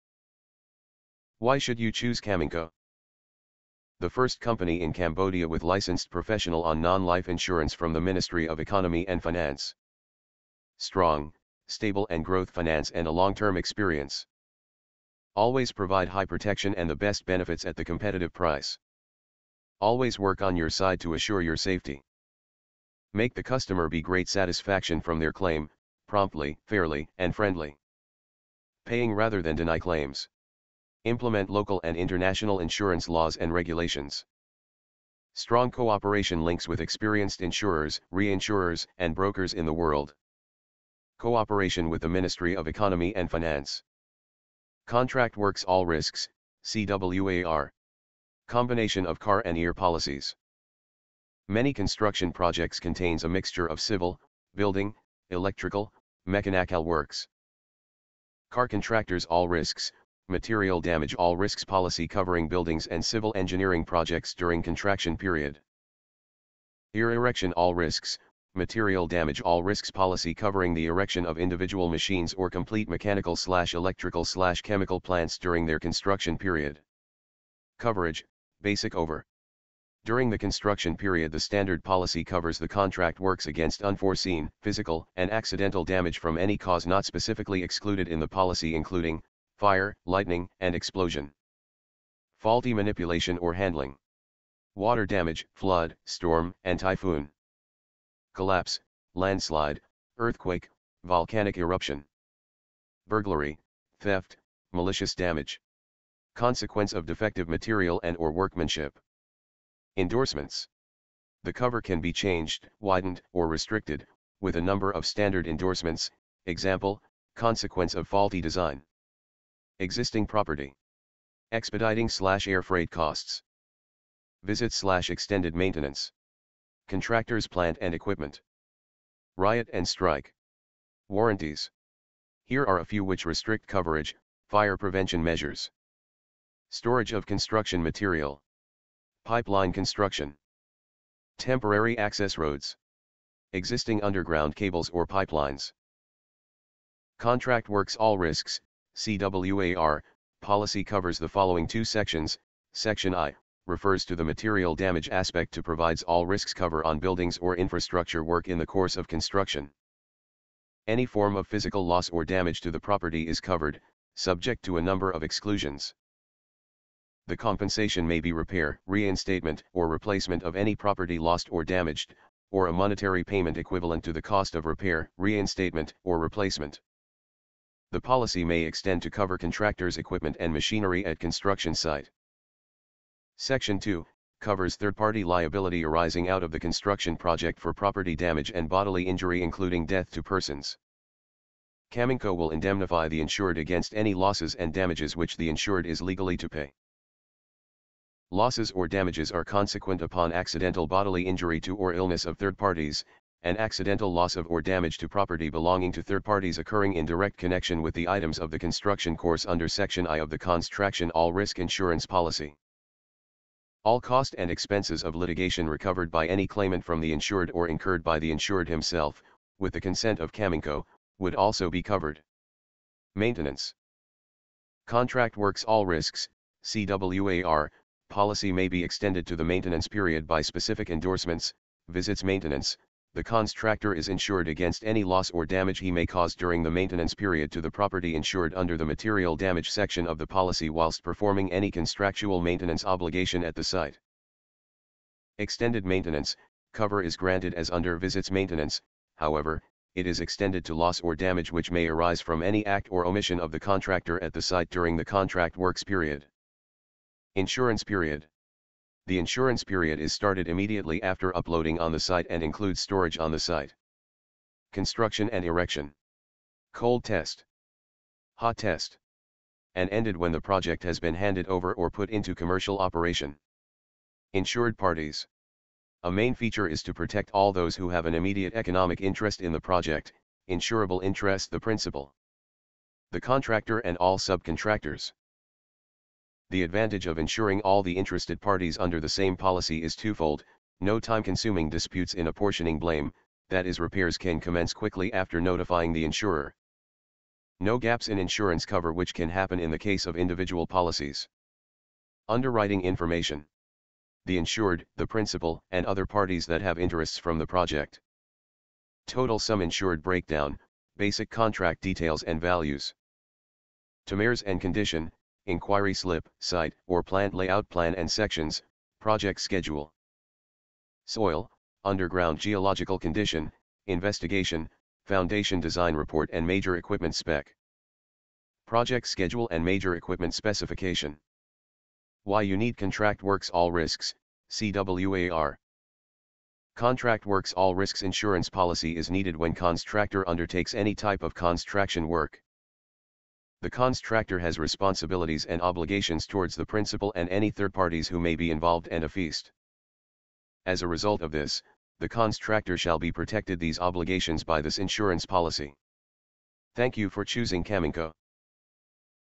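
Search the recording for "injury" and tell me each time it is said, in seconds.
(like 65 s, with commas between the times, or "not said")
189 s, 201 s.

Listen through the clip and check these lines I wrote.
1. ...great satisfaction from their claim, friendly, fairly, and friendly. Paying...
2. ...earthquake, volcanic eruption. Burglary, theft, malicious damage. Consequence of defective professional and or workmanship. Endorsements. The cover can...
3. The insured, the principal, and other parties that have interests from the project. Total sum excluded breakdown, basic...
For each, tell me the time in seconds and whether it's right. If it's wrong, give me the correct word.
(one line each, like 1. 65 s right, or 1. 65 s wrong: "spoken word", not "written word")
1. 24 s wrong: "promptly", not "friendly"
2. 100 s wrong: "material", not "professional"
3. 304 s wrong: "insured", not "excluded".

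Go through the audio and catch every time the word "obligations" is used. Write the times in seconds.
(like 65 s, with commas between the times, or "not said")
242 s, 345 s, 353 s.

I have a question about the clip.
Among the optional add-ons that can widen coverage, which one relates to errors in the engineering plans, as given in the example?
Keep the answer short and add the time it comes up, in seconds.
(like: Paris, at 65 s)
Consequence of faulty design, at 117 s.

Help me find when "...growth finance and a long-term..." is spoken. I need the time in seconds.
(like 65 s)
12 s.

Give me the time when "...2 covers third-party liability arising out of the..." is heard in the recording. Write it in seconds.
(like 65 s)
183 s.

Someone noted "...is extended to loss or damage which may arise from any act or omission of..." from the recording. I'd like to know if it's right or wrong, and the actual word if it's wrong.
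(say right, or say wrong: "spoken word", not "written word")
right.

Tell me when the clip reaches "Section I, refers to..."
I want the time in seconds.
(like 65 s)
152 s.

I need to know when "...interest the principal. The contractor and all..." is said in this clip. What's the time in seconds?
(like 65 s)
281 s.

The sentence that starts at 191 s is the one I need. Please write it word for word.
Caminco will indemnify the insured against any losses and damages which the insured is legally to pay.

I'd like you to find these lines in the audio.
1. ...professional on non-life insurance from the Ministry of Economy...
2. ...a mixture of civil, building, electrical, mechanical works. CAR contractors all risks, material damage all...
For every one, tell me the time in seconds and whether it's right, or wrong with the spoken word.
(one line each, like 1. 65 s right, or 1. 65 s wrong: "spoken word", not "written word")
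1. 6 s right
2. 53 s right.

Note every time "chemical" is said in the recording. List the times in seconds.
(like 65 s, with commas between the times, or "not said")
74 s.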